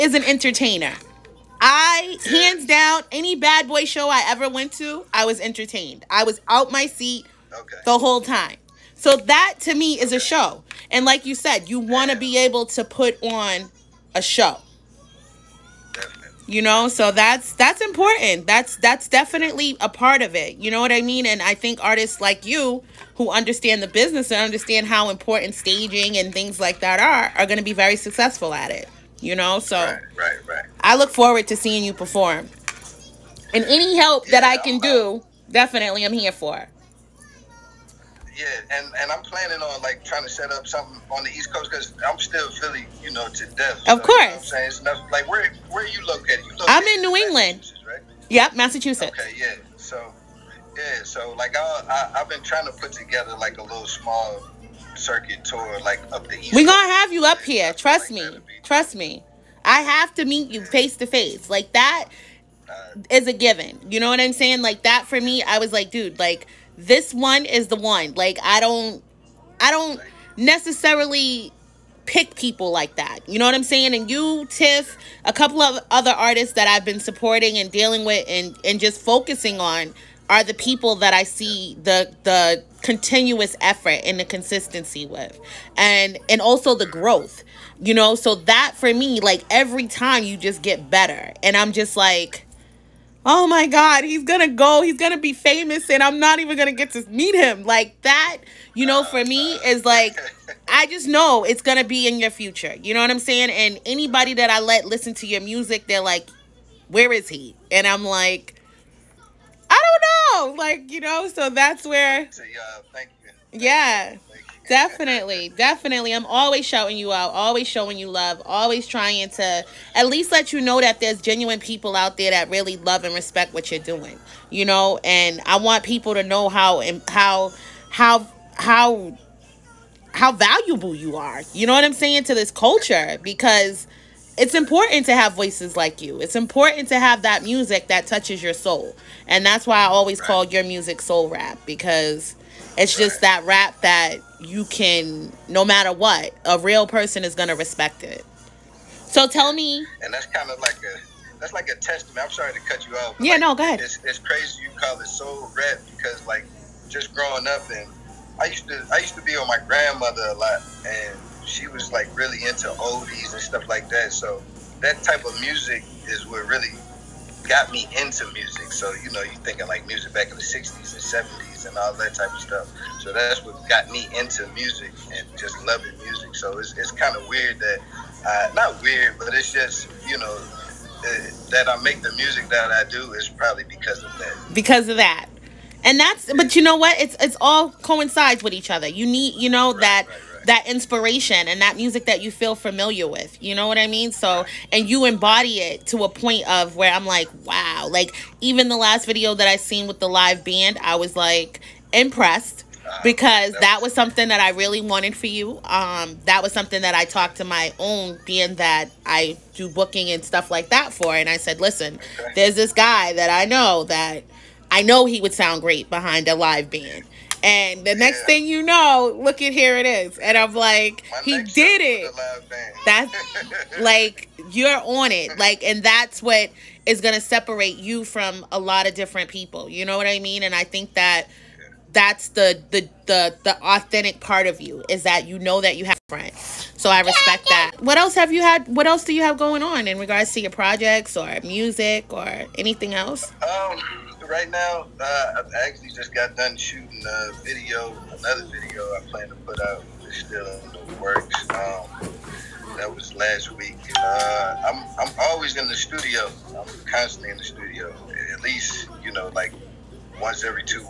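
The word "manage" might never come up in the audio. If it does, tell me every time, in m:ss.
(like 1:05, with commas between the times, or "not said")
not said.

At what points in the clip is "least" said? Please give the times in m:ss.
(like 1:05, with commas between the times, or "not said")
2:00, 4:18.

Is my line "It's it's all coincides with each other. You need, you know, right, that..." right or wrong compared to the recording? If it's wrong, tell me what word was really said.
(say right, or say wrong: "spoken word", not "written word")
right.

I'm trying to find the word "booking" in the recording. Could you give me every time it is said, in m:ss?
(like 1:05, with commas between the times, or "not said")
3:29.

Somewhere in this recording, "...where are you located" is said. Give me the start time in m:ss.
0:45.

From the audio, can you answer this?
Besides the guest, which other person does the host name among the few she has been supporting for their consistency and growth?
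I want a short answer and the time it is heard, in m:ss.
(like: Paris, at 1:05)
Tiff, at 1:14.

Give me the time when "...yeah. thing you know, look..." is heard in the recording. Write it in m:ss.
3:38.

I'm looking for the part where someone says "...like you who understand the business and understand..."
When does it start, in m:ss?
0:22.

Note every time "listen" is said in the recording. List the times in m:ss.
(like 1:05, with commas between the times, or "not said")
1:44, 3:31.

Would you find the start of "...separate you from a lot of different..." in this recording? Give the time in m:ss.
3:47.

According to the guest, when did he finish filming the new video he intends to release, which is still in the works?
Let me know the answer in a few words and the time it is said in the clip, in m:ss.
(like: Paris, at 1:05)
last week, at 4:13.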